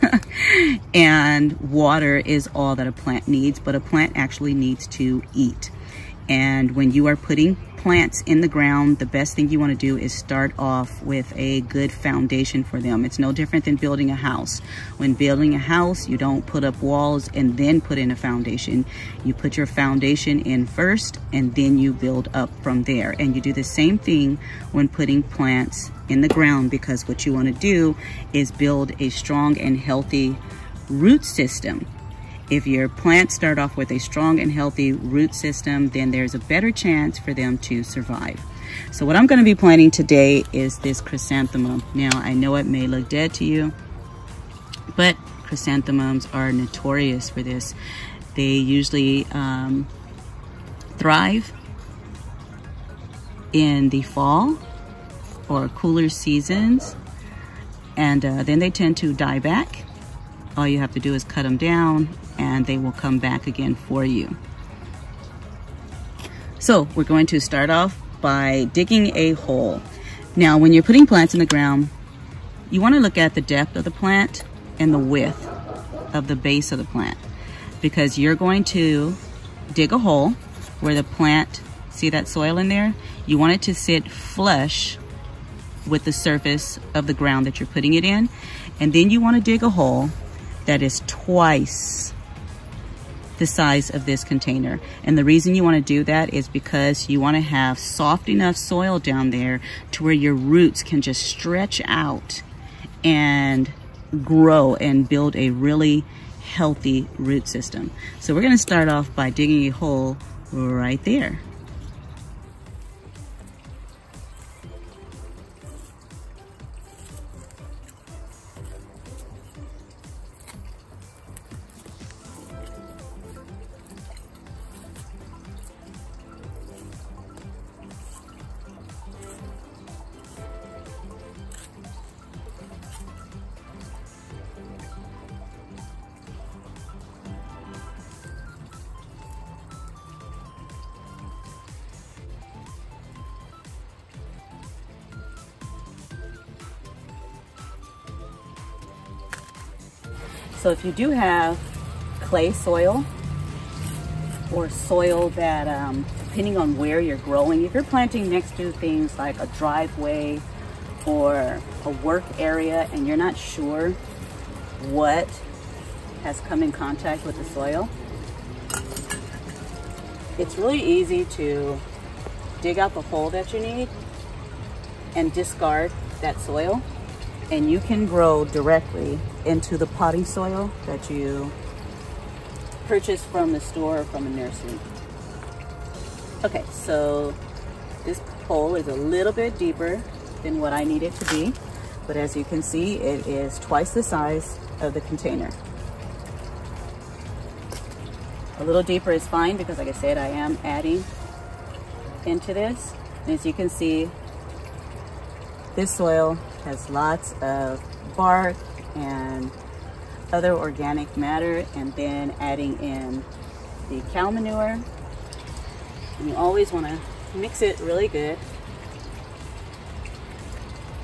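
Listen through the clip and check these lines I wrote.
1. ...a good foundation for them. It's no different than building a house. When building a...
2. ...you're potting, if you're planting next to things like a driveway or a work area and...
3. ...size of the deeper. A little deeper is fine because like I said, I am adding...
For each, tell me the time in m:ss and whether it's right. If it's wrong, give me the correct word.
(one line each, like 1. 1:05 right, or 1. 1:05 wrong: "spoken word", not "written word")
1. 0:11 right
2. 2:36 wrong: "growing", not "potting"
3. 3:14 wrong: "container", not "deeper".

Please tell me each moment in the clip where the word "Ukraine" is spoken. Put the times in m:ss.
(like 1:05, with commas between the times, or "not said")
not said.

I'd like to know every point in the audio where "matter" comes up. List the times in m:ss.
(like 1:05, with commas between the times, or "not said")
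3:31.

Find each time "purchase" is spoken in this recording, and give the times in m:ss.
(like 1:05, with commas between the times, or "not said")
3:02.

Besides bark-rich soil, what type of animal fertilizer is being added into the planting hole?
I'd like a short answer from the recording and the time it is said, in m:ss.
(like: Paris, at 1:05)
Cow manure, at 3:34.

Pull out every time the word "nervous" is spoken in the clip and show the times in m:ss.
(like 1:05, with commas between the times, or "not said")
not said.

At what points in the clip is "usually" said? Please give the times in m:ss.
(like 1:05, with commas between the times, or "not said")
0:48.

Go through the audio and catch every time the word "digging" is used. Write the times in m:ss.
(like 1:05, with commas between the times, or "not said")
1:08, 1:49.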